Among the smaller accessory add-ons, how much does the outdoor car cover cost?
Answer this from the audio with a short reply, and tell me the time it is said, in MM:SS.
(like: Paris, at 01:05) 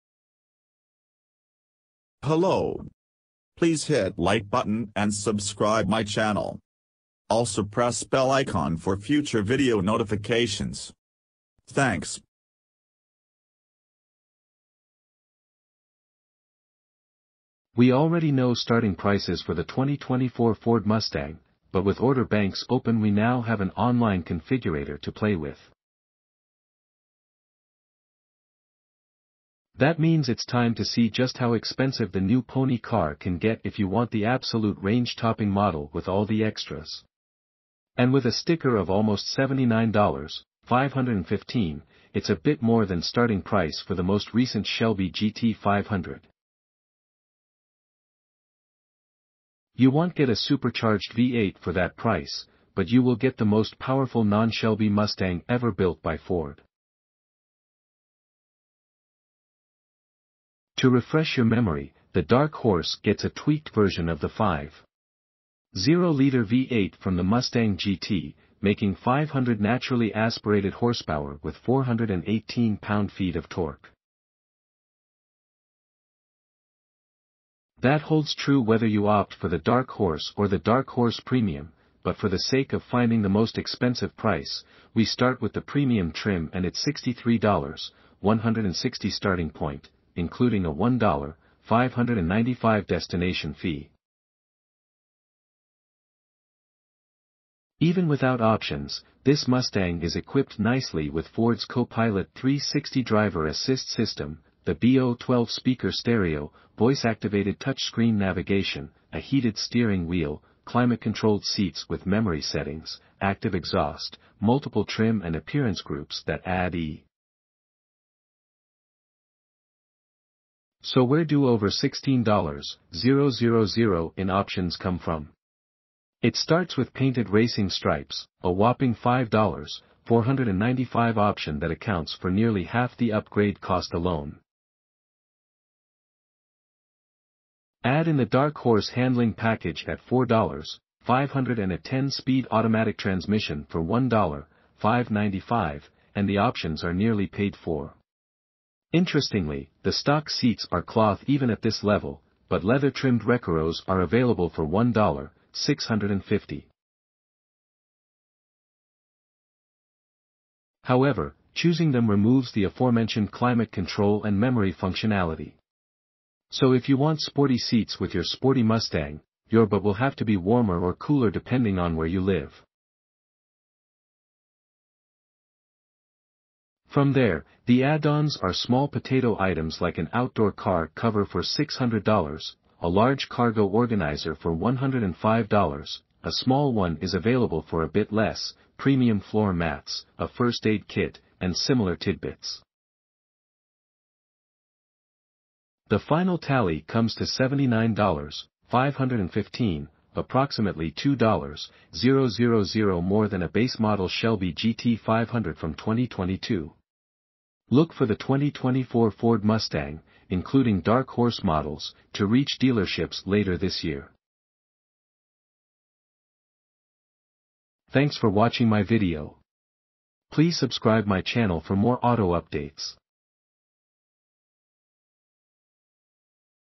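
$600, at 03:01.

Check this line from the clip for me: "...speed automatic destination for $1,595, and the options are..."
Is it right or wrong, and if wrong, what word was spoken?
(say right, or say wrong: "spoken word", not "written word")
wrong: "transmission", not "destination".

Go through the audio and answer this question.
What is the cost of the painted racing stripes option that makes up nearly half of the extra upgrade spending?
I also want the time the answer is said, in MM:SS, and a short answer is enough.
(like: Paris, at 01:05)
$5,495, at 02:08.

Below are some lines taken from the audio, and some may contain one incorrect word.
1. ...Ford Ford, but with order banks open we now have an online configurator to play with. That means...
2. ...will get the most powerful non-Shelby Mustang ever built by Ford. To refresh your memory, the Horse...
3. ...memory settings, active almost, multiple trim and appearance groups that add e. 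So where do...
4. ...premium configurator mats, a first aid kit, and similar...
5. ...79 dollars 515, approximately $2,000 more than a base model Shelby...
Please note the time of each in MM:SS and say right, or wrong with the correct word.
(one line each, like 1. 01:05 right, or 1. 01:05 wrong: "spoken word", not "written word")
1. 00:20 wrong: "Mustang", not "Ford"
2. 00:53 wrong: "Dark", not "Horse"
3. 01:52 wrong: "exhaust", not "almost"
4. 03:08 wrong: "floor", not "configurator"
5. 03:17 right.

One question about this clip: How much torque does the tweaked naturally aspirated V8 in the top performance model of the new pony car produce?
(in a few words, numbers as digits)
418 pound-feet.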